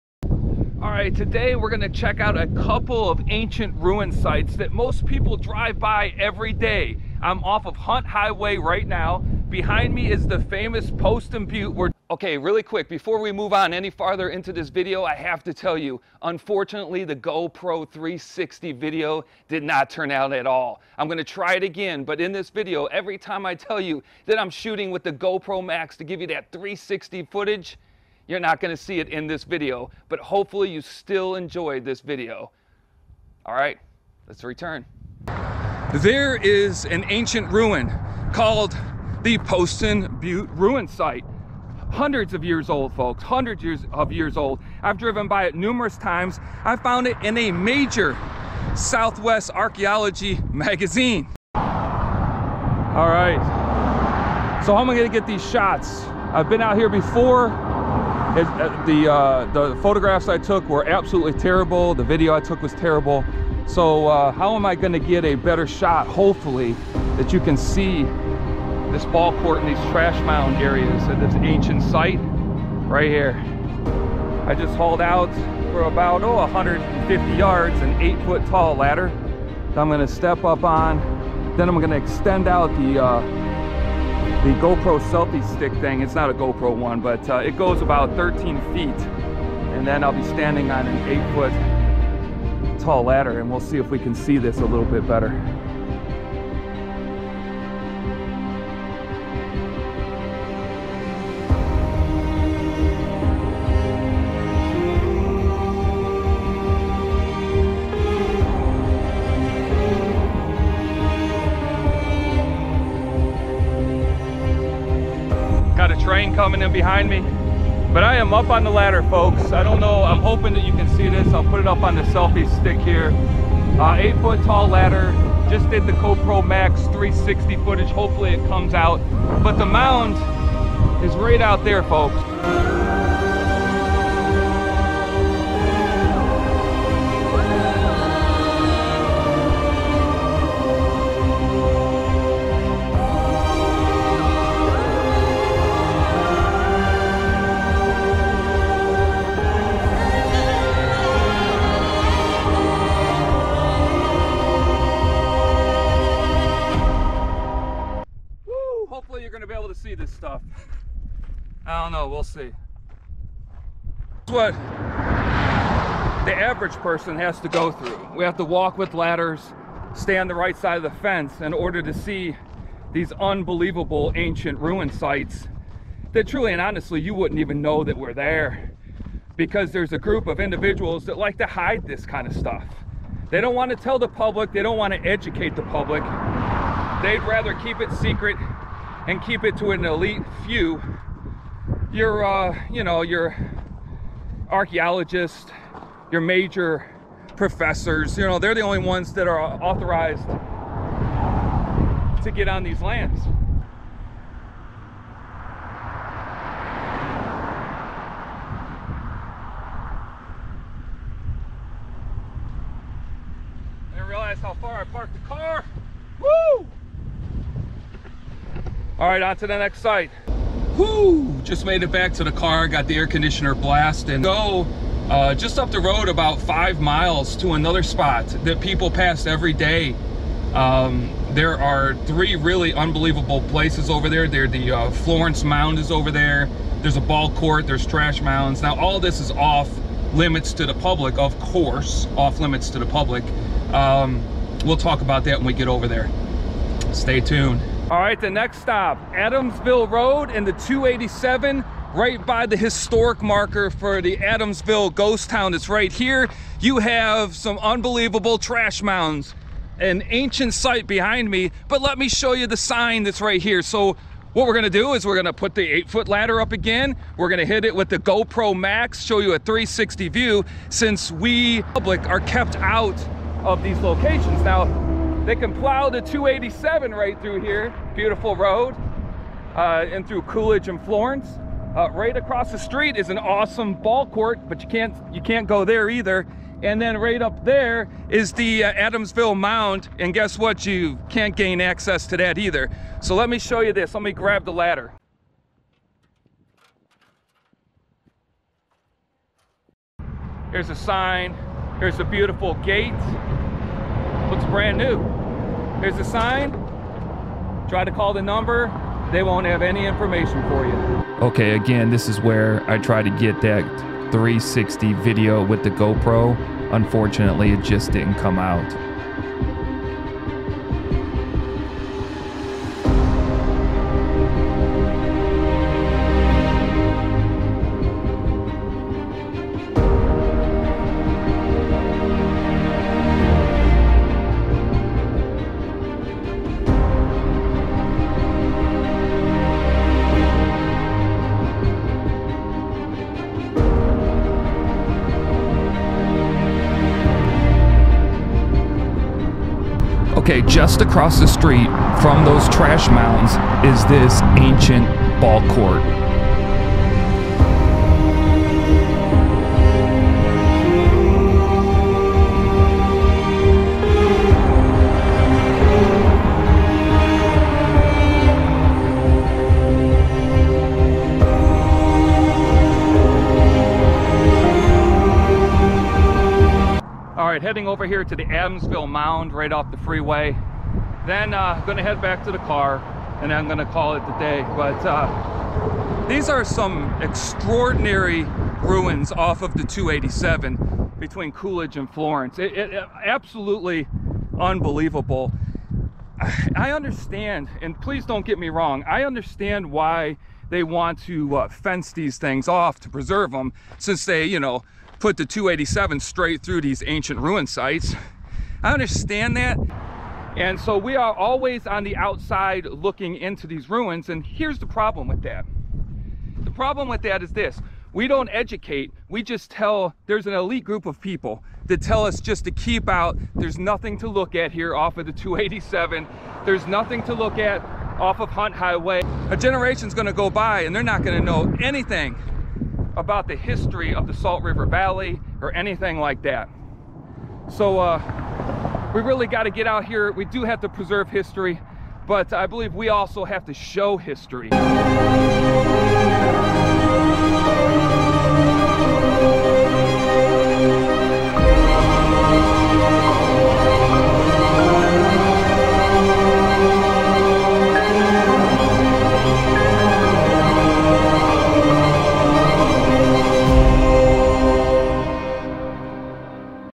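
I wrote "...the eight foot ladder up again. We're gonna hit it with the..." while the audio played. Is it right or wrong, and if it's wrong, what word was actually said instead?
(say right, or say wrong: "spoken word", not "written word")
right.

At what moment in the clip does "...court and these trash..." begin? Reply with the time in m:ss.
1:09.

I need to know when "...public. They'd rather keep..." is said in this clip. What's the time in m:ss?
3:05.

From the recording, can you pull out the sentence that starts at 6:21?
Then uh, gonna head back to the car and I'm gonna call it the day.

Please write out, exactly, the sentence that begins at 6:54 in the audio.
And here's the problem with that.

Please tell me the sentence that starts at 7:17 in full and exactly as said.
So uh, we really got to get out here.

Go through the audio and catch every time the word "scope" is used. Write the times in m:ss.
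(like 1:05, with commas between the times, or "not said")
not said.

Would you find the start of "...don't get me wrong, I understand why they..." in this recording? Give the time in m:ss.
6:38.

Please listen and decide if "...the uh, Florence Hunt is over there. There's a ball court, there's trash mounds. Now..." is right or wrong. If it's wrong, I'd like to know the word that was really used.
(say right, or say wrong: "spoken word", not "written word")
wrong: "Mound", not "Hunt".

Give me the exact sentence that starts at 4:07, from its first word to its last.
All right, the next stop, Adamsville Road and the 287 right by the historic marker for the Adamsville ghost town.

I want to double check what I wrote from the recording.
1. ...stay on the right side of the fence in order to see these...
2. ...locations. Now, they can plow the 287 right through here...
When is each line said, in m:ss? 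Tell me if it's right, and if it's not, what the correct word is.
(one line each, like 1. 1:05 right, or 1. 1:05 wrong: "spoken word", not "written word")
1. 2:49 right
2. 4:33 right.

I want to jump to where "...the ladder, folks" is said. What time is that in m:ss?
1:58.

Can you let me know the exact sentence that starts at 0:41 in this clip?
Hundreds of years old, folks, hundreds years of years old.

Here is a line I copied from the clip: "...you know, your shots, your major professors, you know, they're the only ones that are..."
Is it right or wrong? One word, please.
wrong.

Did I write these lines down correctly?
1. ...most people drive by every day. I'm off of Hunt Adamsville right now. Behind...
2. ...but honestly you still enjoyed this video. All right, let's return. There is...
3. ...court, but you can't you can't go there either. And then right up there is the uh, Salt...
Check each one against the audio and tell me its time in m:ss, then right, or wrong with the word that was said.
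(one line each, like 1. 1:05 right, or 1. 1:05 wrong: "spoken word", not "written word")
1. 0:04 wrong: "Highway", not "Adamsville"
2. 0:30 wrong: "hopefully", not "honestly"
3. 4:44 wrong: "Adamsville", not "Salt".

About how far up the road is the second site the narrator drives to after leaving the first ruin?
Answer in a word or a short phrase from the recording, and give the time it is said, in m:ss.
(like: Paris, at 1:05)
5 miles, at 3:46.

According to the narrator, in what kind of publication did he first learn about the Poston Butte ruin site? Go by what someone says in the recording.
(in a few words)
Southwest Archaeology magazine.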